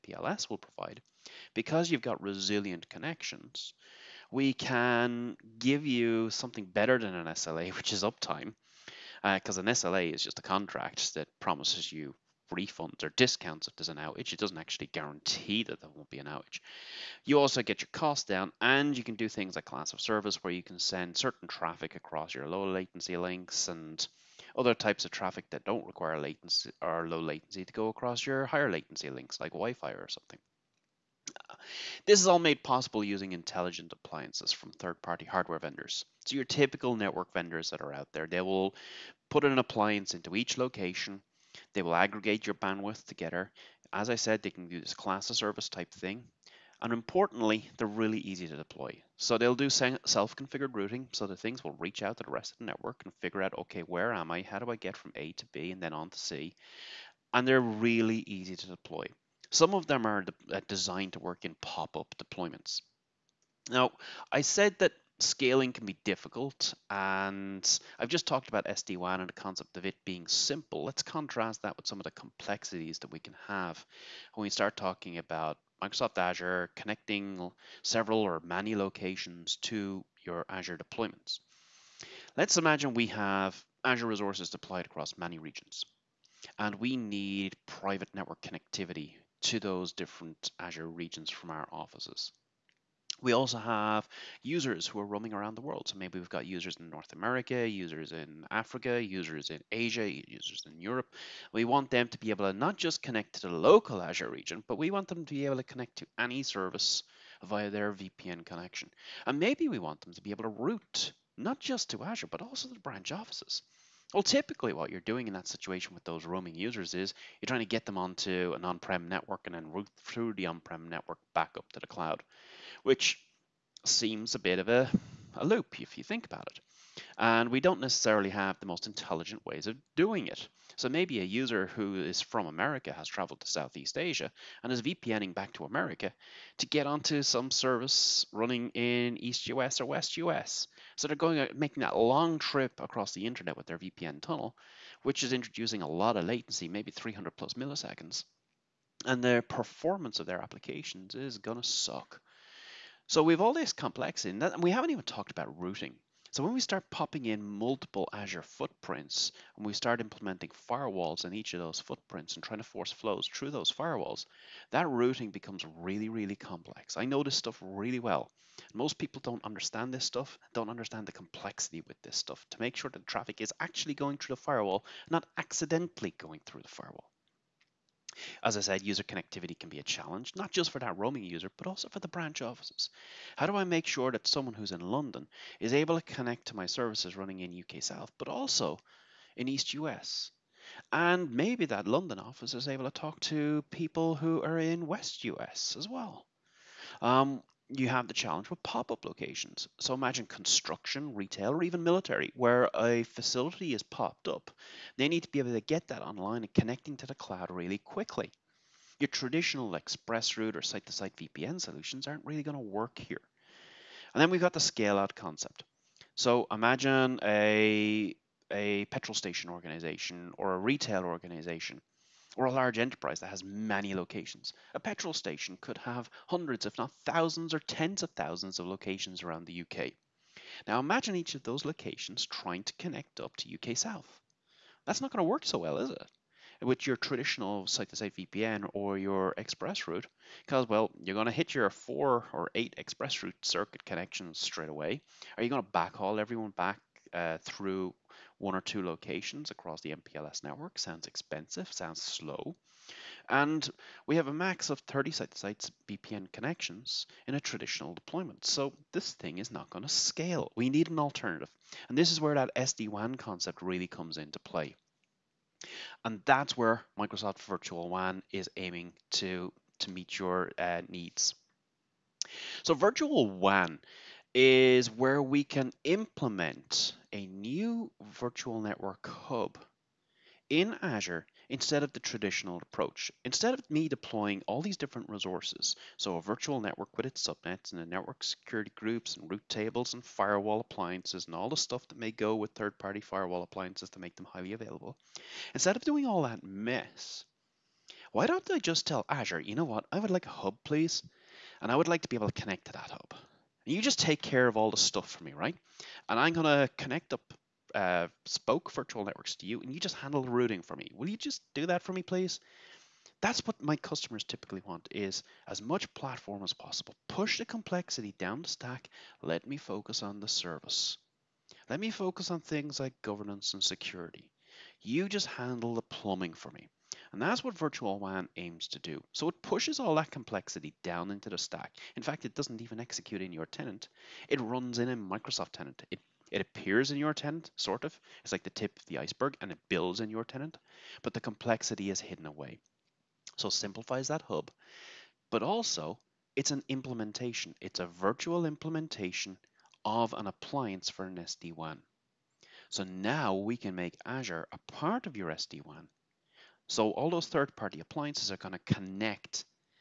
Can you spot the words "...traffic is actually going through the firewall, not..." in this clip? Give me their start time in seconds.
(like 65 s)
173 s.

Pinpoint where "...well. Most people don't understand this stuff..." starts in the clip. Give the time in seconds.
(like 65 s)
167 s.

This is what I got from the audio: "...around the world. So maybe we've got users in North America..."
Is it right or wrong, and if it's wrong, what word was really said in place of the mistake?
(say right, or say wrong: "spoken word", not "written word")
right.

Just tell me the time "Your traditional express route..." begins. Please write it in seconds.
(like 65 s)
208 s.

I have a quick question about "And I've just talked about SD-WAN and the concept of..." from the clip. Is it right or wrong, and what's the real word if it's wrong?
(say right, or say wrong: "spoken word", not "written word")
right.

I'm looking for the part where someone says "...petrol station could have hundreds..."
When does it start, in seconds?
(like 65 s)
224 s.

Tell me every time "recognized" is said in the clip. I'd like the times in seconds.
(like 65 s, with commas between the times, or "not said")
not said.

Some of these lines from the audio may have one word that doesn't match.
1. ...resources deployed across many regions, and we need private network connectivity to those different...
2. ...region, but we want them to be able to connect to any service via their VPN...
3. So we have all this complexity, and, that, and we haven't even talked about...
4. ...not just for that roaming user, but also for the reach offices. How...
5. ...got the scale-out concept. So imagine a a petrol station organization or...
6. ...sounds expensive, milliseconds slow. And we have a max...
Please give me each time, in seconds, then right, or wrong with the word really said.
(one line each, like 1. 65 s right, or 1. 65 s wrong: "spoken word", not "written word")
1. 84 s right
2. 104 s right
3. 153 s right
4. 180 s wrong: "branch", not "reach"
5. 214 s right
6. 250 s wrong: "sounds", not "milliseconds".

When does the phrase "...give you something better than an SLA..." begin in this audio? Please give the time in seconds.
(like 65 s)
5 s.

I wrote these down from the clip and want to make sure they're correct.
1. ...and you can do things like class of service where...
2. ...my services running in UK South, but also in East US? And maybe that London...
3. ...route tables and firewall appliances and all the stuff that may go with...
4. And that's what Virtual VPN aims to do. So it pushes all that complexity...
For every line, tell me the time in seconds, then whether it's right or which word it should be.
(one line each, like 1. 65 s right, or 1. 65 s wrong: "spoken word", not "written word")
1. 18 s right
2. 186 s right
3. 289 s right
4. 327 s wrong: "WAN", not "VPN".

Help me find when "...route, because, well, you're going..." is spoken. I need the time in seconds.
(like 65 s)
239 s.